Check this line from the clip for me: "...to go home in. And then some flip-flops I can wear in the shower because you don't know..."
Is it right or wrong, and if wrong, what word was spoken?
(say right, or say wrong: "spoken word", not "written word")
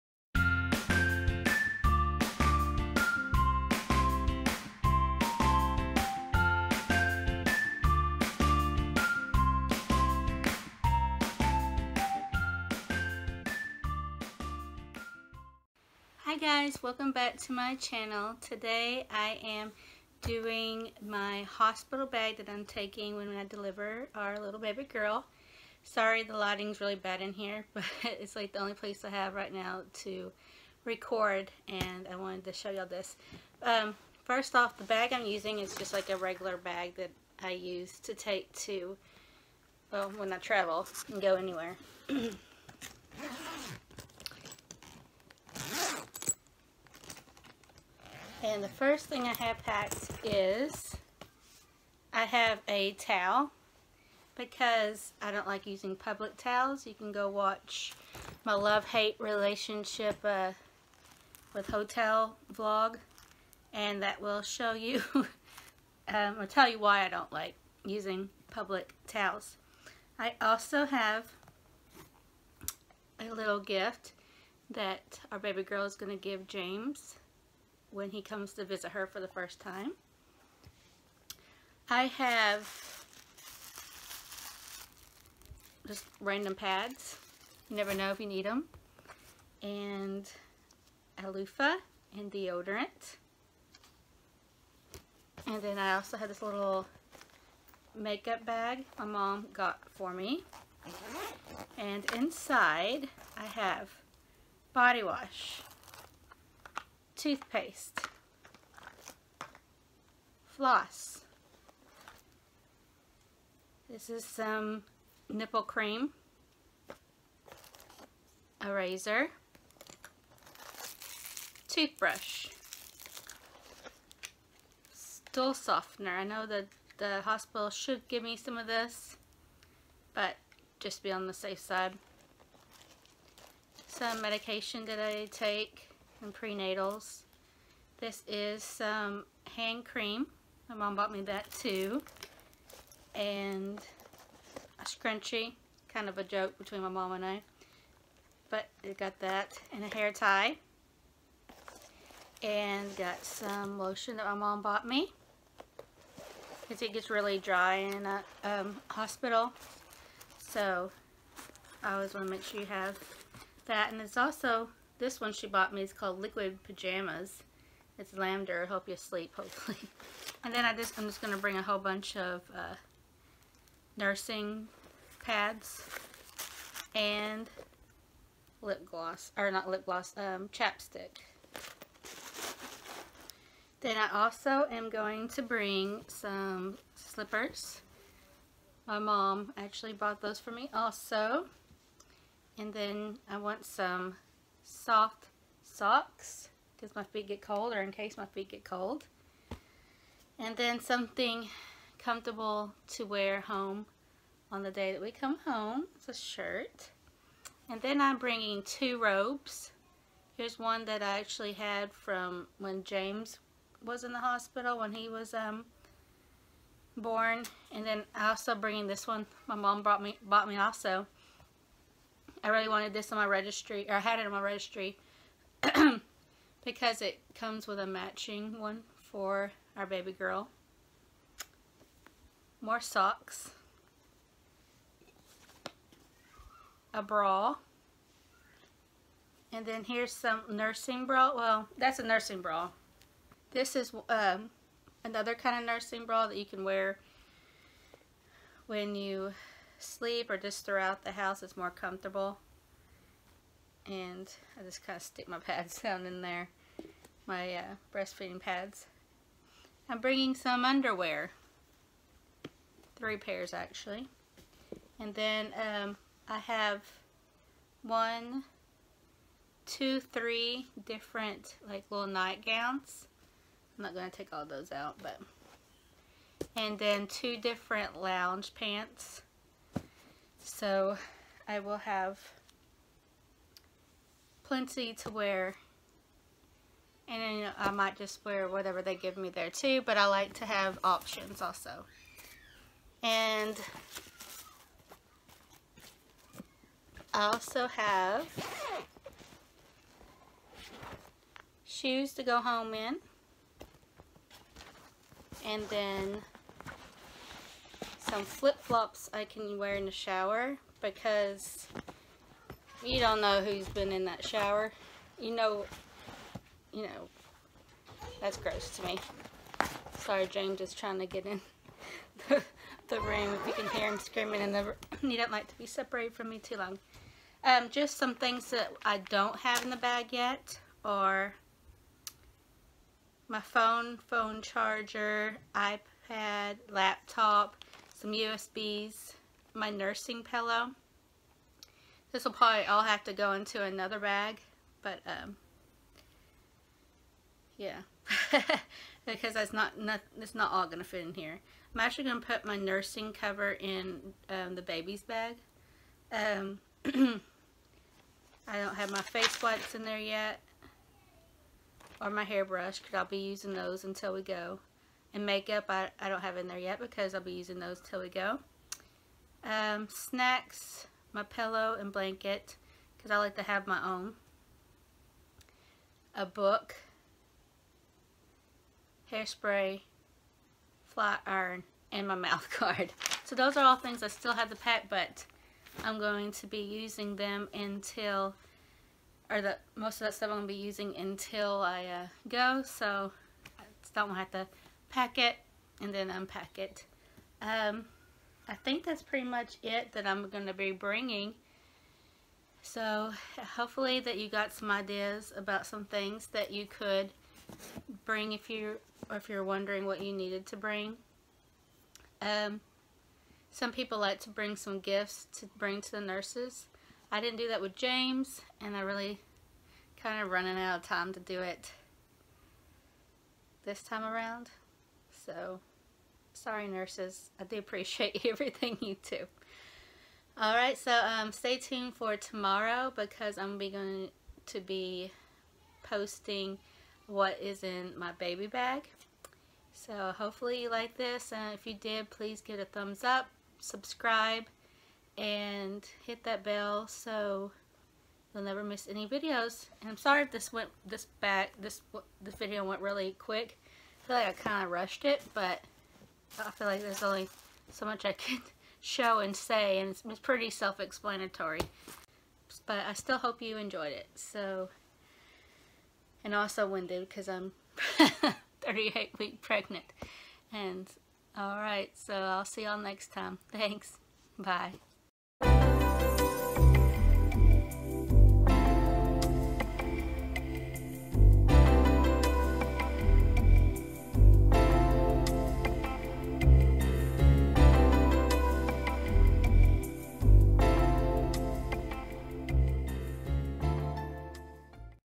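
right.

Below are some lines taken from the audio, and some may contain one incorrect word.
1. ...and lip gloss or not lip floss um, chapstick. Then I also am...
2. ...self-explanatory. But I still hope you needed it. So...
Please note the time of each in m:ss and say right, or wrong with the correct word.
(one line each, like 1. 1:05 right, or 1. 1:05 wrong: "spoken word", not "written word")
1. 2:56 wrong: "gloss", not "floss"
2. 7:40 wrong: "enjoyed", not "needed".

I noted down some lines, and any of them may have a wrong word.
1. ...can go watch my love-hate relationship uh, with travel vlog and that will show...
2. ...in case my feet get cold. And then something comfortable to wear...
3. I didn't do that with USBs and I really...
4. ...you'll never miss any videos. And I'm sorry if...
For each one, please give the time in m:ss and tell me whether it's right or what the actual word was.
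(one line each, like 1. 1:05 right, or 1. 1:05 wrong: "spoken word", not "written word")
1. 0:56 wrong: "hotel", not "travel"
2. 3:17 right
3. 6:57 wrong: "James", not "USBs"
4. 7:28 right.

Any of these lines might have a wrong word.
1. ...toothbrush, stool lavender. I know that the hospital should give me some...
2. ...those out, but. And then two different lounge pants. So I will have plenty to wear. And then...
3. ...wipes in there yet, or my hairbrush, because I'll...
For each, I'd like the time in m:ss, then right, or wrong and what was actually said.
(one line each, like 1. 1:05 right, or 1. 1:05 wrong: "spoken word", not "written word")
1. 2:01 wrong: "softener", not "lavender"
2. 4:34 right
3. 5:59 right.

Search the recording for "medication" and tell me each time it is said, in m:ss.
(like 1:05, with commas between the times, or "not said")
2:14.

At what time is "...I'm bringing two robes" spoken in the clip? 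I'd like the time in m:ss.
3:28.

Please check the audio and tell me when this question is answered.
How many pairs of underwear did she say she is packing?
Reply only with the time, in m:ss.
4:22.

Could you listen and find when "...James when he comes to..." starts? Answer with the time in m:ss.
1:16.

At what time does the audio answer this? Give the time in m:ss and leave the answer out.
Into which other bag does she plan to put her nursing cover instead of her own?
5:54.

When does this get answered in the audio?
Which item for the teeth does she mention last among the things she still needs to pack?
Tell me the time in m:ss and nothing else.
6:22.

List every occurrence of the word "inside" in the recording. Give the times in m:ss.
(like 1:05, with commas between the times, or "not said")
1:42.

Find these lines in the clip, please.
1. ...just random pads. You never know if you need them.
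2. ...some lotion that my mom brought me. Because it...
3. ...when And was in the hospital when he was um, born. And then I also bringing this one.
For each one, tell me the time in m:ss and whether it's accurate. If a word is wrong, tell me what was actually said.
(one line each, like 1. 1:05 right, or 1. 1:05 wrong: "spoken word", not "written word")
1. 1:25 right
2. 2:33 wrong: "bought", not "brought"
3. 3:32 wrong: "James", not "And".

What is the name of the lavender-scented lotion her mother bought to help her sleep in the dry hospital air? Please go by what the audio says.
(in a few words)
Liquid Pajamas.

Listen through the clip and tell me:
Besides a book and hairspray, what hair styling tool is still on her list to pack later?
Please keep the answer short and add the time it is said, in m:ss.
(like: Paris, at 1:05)
flat iron, at 6:20.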